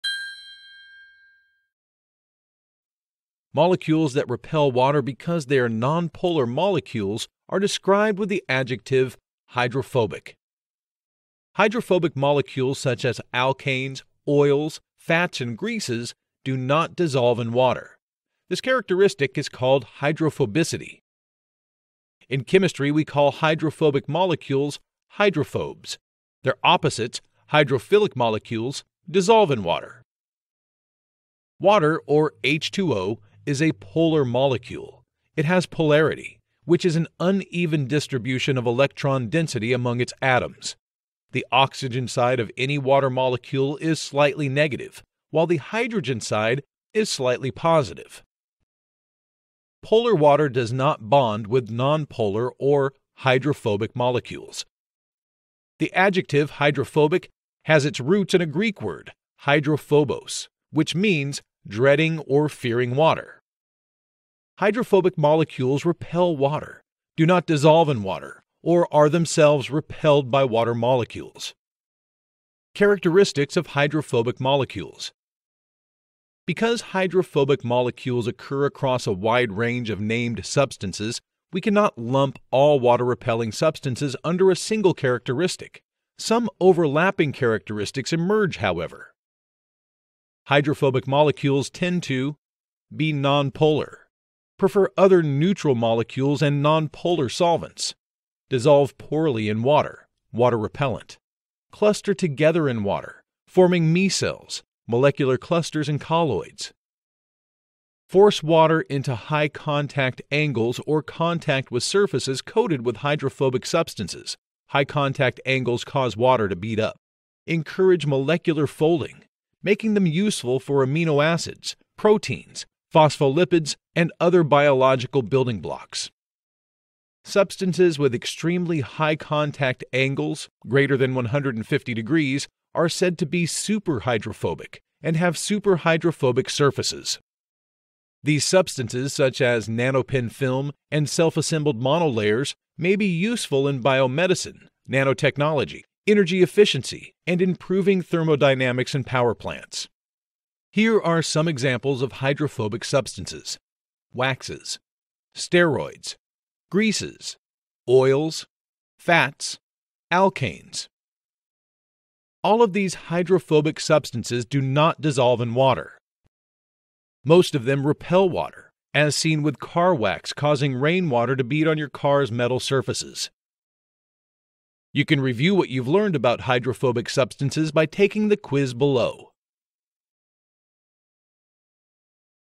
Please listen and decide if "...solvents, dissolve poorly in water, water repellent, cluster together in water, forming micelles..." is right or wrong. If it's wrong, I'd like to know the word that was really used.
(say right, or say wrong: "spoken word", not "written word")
right.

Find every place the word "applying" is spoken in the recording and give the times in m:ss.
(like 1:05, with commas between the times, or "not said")
not said.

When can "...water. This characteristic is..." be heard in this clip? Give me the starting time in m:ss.
0:17.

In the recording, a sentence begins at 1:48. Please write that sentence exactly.
Force water into high contact angles or contact with surfaces coated with hydrophobic substances.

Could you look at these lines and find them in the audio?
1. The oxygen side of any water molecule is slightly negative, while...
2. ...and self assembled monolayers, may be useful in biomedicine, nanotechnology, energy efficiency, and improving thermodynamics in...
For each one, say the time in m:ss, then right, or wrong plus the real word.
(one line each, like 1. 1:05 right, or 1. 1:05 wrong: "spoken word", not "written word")
1. 0:41 right
2. 2:20 right.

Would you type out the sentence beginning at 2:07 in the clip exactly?
Substances with extremely high contact angles, greater than 150 degrees, are said to be superhydrophobic and have superhydrophobic surfaces.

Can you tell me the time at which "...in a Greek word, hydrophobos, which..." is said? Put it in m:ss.
0:58.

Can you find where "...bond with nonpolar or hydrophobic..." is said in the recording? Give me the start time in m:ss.
0:51.